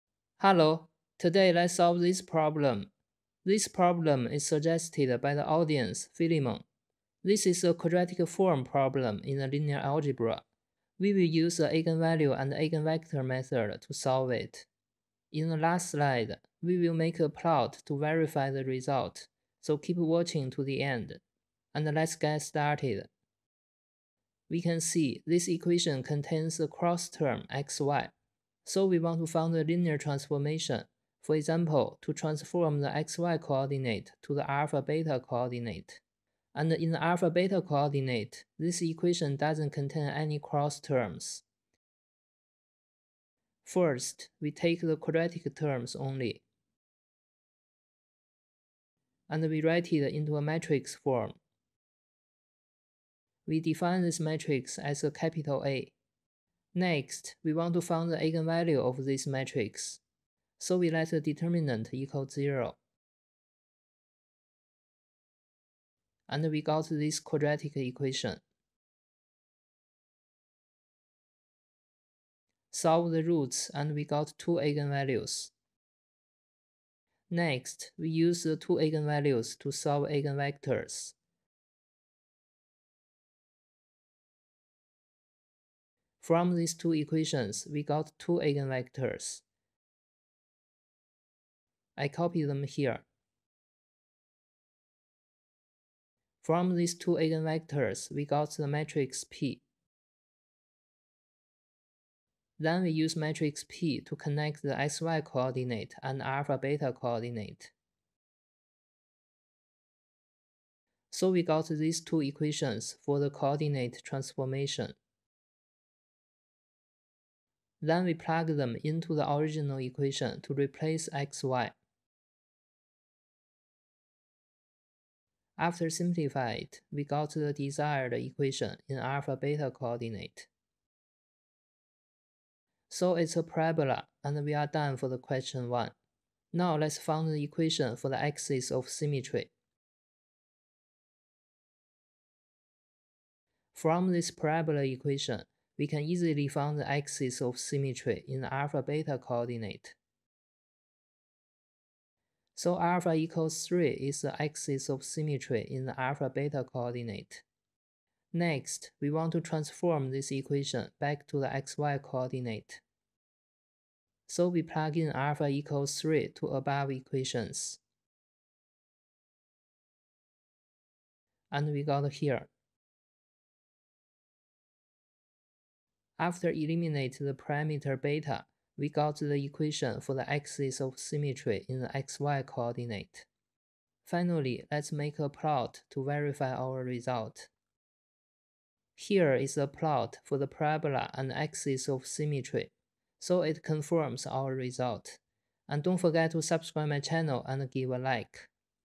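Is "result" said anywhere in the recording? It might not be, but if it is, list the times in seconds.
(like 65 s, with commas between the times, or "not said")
18 s, 186 s, 194 s.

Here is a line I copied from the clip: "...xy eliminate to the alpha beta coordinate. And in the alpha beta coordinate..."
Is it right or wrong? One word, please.
wrong.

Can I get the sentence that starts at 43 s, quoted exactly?
First, we take the quadratic terms only.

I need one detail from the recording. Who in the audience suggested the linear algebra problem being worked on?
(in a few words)
Philemon.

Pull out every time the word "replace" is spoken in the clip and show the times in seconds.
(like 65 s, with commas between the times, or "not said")
120 s.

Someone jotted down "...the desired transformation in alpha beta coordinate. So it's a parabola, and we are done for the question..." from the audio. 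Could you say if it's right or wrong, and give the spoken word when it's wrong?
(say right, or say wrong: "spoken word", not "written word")
wrong: "equation", not "transformation".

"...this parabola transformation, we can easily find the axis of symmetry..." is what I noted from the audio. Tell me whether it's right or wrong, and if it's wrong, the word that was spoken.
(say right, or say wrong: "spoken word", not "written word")
wrong: "equation", not "transformation".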